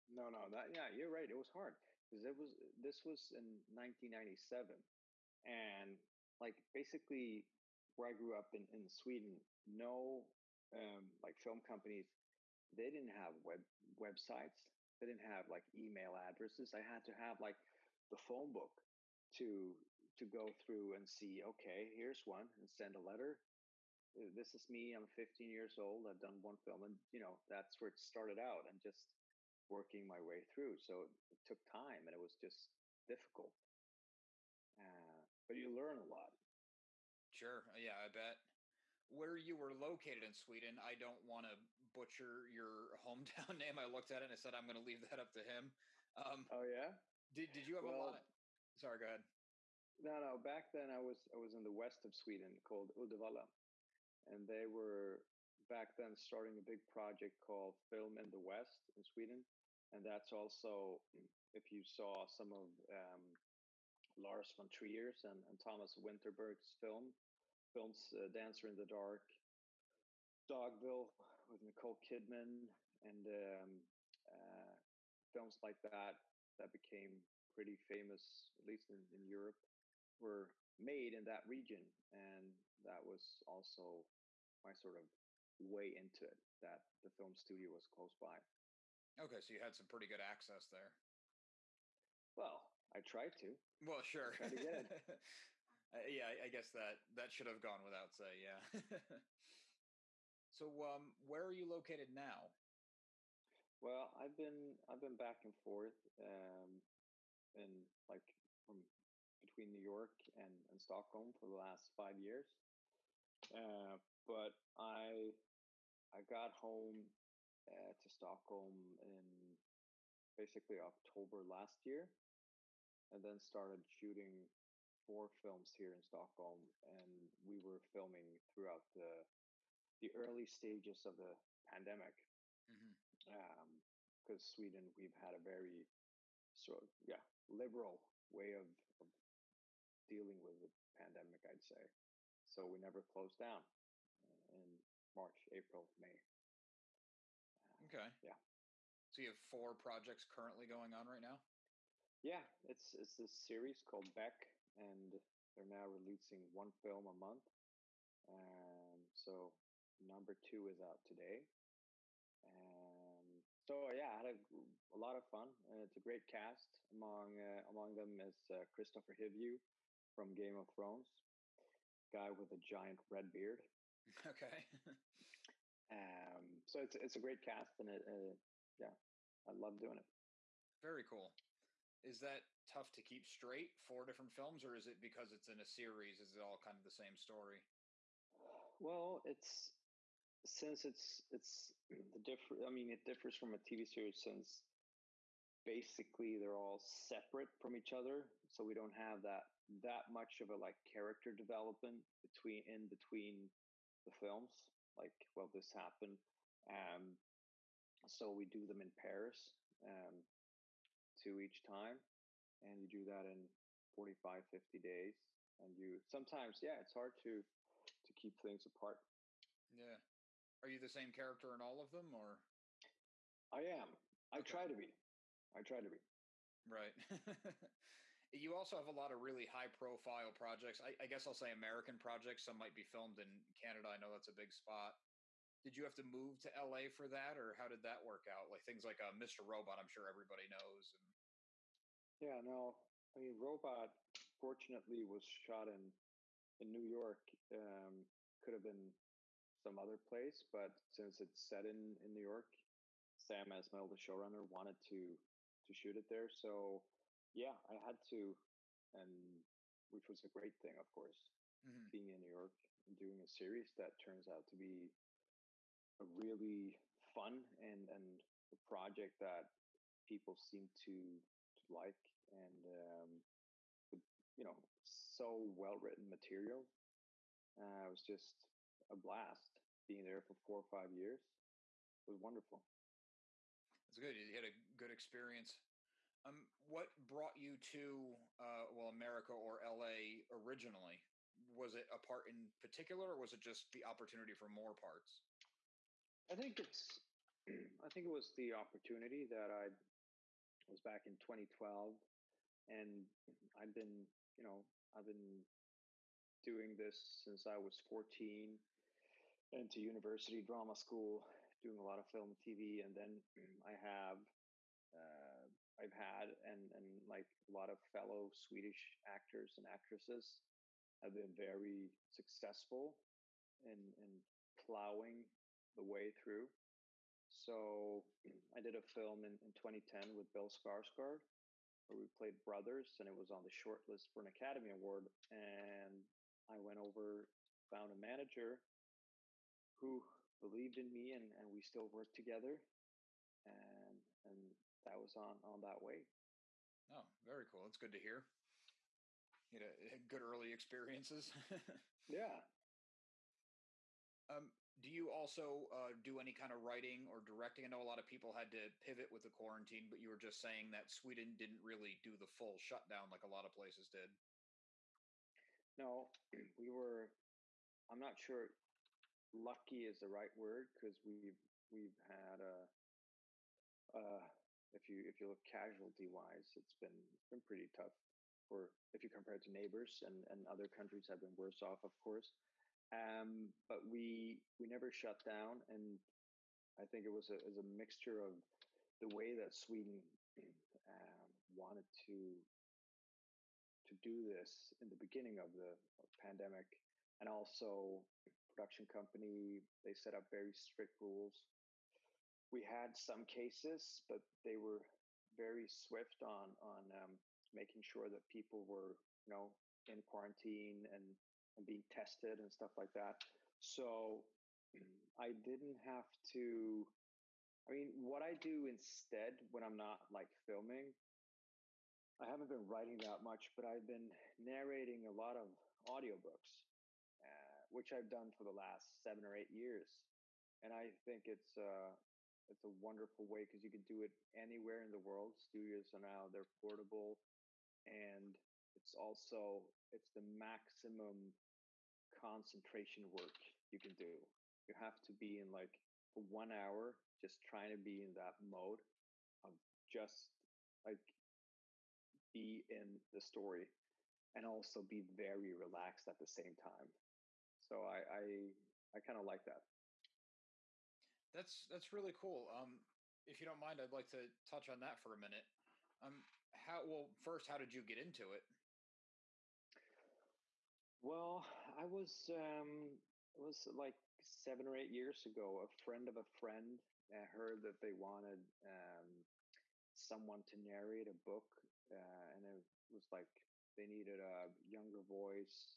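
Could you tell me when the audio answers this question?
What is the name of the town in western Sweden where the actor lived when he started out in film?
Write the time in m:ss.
0:52.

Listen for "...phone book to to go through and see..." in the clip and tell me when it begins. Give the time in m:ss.
0:18.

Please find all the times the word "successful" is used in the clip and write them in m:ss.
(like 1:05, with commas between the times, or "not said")
5:22.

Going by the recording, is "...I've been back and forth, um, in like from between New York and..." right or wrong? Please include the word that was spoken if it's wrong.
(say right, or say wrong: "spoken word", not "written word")
right.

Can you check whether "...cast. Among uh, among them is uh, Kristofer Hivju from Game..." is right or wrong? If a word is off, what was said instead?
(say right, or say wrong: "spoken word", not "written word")
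right.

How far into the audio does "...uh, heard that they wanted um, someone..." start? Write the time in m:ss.
7:57.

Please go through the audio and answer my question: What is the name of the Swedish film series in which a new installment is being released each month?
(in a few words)
Beck.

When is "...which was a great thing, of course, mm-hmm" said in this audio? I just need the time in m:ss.
4:19.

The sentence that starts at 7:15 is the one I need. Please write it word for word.
Studios are now they're portable, and it's also it's the maximum concentration work you can do.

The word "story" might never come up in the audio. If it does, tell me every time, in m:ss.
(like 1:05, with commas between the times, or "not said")
3:07, 7:33.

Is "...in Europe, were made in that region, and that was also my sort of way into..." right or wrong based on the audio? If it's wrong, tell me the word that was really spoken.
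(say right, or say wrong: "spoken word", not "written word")
right.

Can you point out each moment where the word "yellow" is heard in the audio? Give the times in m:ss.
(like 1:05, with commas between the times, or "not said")
not said.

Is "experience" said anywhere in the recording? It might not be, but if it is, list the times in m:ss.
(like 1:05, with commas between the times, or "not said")
4:44, 5:50.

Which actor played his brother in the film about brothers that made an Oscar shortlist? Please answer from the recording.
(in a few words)
Bill Skarsgård.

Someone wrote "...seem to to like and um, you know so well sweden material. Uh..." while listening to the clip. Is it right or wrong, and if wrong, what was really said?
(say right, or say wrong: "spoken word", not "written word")
wrong: "written", not "sweden".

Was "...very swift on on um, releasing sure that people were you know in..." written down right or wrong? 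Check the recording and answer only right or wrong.
wrong.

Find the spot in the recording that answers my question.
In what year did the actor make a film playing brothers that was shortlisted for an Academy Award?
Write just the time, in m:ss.
5:29.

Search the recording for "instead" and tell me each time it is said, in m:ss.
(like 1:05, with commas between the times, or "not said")
6:58.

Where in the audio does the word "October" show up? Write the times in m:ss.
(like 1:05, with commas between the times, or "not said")
2:00.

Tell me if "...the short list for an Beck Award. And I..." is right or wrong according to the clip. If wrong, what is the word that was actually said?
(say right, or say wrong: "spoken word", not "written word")
wrong: "Academy", not "Beck".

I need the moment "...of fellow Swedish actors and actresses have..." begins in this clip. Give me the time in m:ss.
5:17.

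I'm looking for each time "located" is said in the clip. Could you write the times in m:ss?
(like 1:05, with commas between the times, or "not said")
0:39, 1:41.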